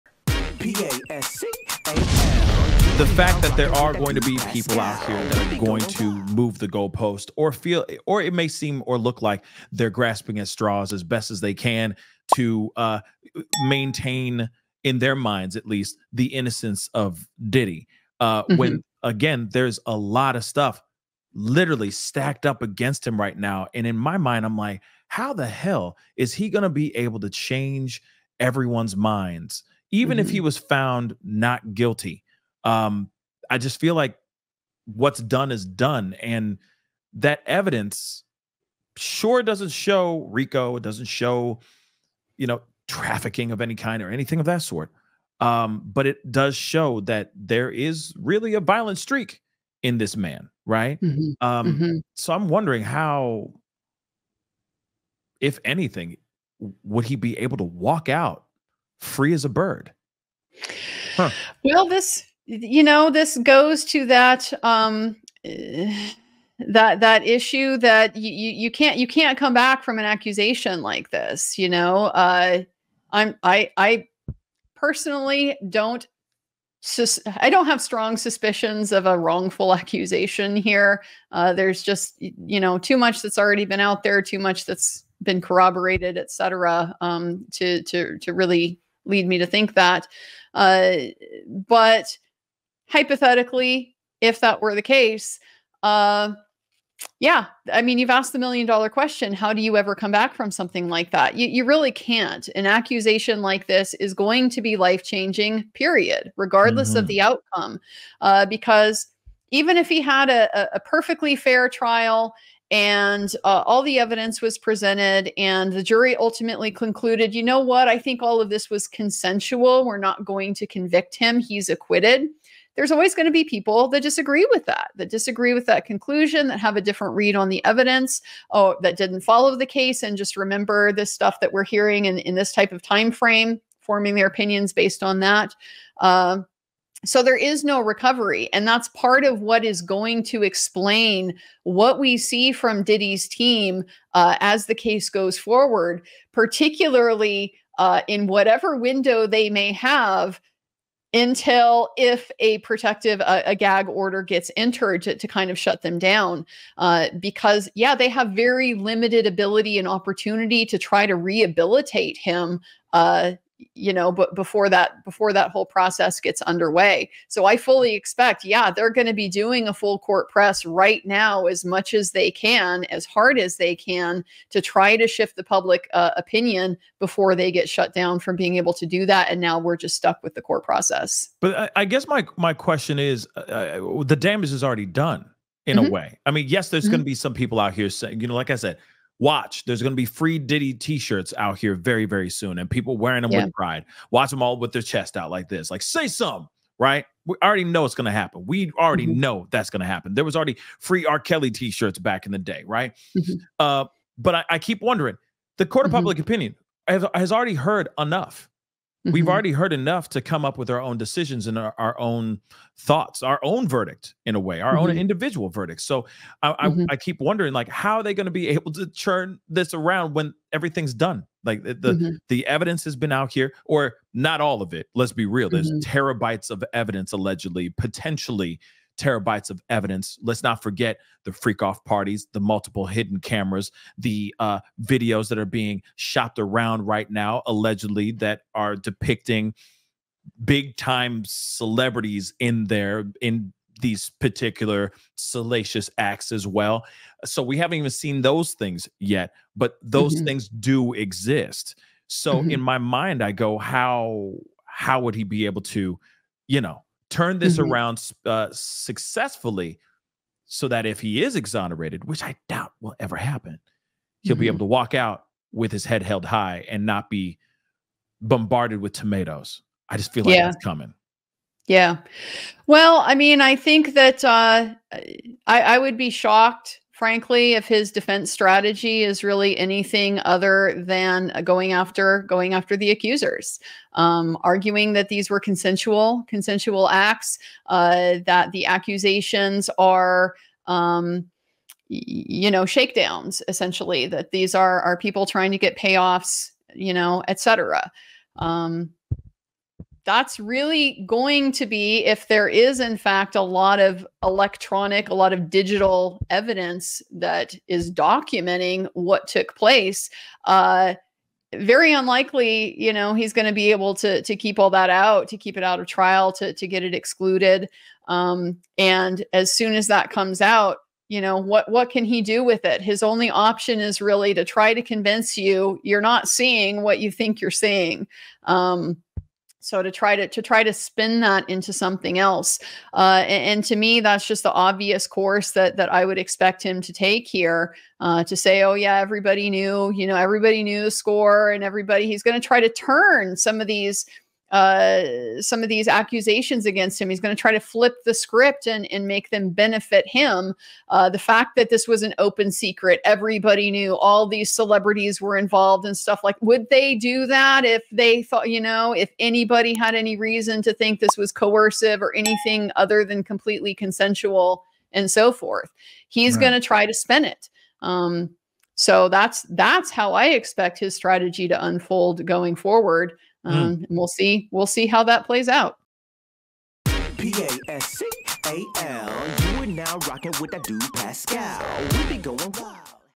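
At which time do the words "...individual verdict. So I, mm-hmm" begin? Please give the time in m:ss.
3:34.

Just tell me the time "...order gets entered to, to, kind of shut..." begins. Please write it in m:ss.
2:33.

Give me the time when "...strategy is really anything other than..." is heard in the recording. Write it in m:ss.
4:38.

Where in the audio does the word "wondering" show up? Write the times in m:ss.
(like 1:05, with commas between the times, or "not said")
0:52, 3:24, 3:37.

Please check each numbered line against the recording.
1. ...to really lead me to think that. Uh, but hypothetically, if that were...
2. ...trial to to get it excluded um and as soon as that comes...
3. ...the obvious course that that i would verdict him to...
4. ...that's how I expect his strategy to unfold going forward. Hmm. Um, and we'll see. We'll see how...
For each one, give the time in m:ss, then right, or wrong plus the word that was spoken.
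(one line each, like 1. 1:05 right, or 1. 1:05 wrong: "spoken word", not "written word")
1. 1:28 right
2. 5:15 right
3. 5:34 wrong: "expect", not "verdict"
4. 6:09 right.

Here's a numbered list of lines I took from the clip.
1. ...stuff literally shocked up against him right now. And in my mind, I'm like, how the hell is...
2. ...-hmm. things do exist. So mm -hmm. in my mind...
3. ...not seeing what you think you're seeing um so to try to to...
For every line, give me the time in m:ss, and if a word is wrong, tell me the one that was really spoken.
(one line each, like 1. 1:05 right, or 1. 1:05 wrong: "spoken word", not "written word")
1. 0:20 wrong: "stacked", not "shocked"
2. 4:10 right
3. 5:26 right.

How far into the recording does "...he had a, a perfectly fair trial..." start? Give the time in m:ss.
1:49.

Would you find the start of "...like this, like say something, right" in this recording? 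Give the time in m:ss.
3:15.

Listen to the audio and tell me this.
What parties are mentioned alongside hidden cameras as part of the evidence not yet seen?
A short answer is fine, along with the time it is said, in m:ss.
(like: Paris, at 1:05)
Freak off parties, at 3:51.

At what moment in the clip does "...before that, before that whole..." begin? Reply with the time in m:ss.
2:44.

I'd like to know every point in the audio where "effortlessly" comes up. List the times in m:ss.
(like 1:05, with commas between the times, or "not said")
not said.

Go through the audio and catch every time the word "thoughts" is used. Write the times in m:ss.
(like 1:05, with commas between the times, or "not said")
3:32, 5:58.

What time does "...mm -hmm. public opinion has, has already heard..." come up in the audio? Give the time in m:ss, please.
3:25.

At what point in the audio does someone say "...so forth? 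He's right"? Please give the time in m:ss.
6:05.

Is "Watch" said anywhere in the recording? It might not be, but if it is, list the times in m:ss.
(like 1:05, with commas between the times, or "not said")
3:09, 3:14.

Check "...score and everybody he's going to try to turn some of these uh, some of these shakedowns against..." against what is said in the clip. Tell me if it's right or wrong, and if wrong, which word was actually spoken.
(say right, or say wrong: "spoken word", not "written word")
wrong: "accusations", not "shakedowns".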